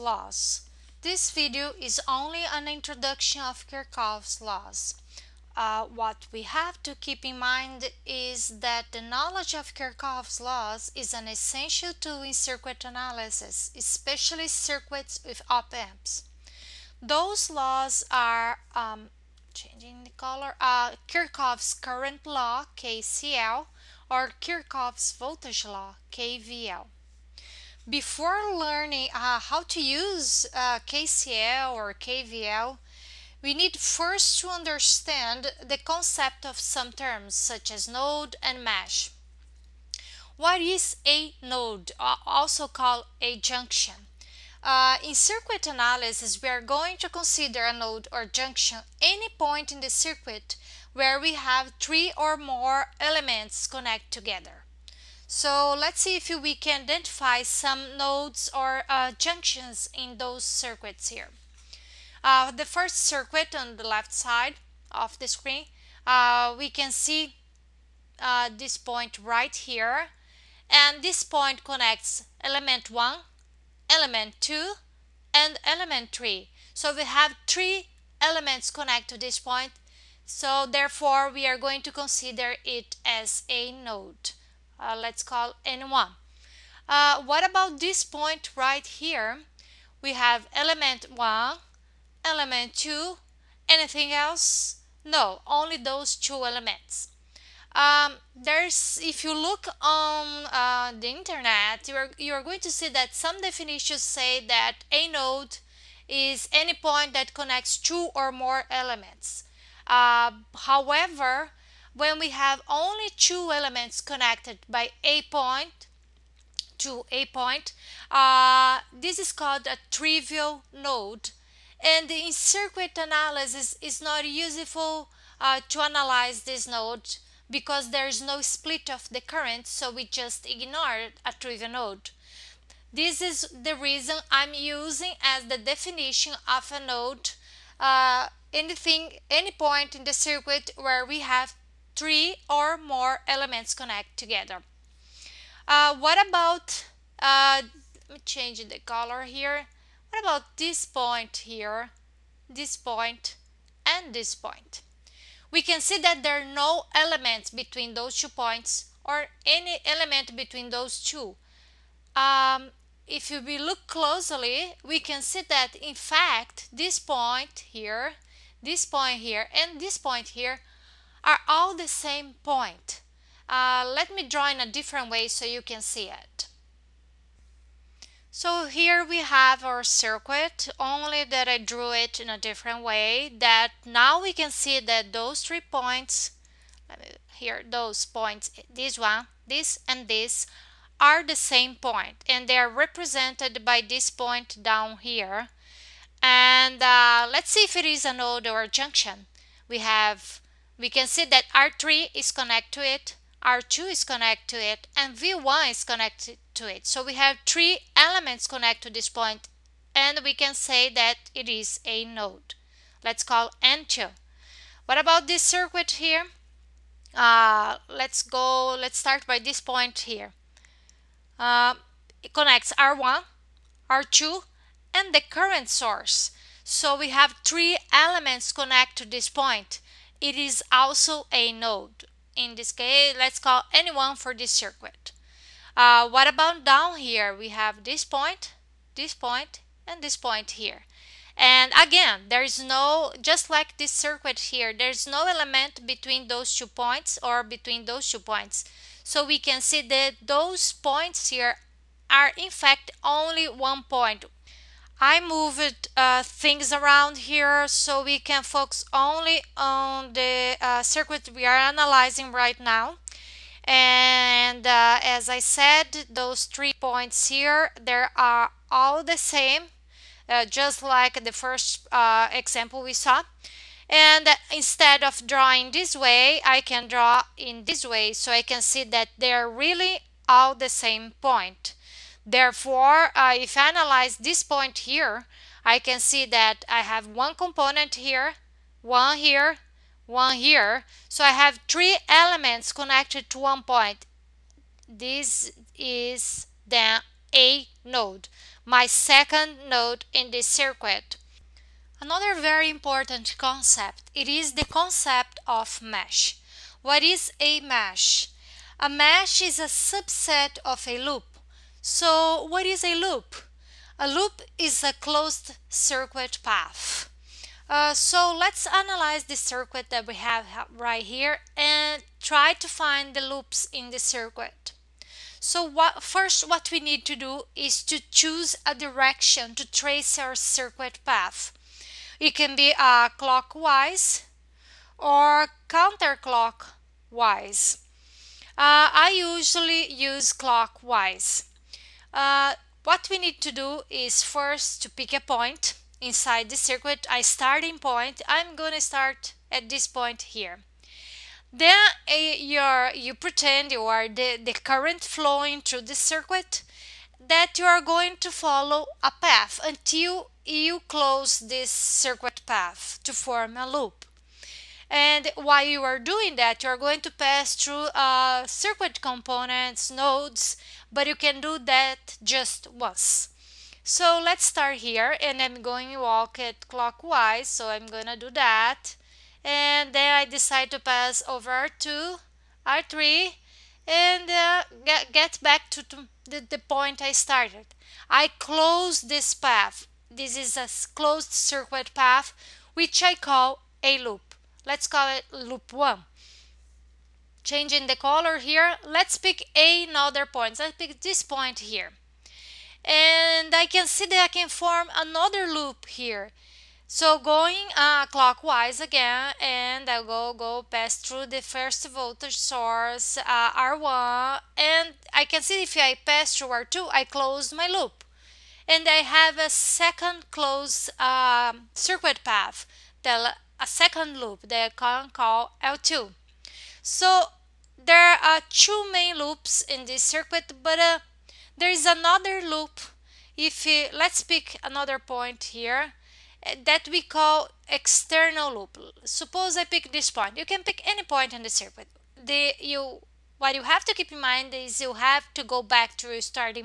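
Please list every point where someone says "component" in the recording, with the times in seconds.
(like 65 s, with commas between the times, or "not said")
287 s, 369 s.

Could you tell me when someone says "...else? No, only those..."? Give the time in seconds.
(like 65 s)
94 s.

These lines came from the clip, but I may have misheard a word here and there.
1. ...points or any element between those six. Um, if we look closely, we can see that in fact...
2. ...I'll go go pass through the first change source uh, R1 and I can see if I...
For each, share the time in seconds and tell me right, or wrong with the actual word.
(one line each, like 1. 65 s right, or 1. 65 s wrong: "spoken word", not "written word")
1. 158 s wrong: "two", not "six"
2. 409 s wrong: "voltage", not "change".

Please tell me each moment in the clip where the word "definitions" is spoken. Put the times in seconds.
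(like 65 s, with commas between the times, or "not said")
103 s, 135 s.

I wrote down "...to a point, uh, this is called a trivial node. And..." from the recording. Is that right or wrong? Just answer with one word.
right.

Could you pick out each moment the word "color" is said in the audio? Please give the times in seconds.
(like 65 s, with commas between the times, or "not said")
20 s, 148 s, 397 s.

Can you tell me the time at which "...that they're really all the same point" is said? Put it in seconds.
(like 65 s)
278 s.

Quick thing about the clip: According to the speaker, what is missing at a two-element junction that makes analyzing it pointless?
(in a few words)
split of the current.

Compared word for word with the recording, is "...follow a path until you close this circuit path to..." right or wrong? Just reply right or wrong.
right.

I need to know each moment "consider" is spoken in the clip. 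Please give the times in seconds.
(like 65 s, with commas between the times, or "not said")
47 s, 81 s.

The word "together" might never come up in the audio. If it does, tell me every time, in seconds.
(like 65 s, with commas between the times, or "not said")
54 s, 144 s.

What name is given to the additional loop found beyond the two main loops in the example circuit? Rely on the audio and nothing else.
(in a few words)
external loop.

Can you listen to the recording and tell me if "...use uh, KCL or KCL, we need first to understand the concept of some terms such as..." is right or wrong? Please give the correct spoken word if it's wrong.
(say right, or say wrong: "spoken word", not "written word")
wrong: "KVL", not "KCL".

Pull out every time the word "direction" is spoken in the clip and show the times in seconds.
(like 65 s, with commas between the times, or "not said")
328 s.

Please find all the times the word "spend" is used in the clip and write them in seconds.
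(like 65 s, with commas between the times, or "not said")
not said.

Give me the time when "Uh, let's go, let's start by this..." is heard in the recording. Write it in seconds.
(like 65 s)
217 s.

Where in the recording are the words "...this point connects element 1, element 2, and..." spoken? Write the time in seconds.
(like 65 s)
71 s.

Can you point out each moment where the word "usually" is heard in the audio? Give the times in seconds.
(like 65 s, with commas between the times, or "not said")
339 s.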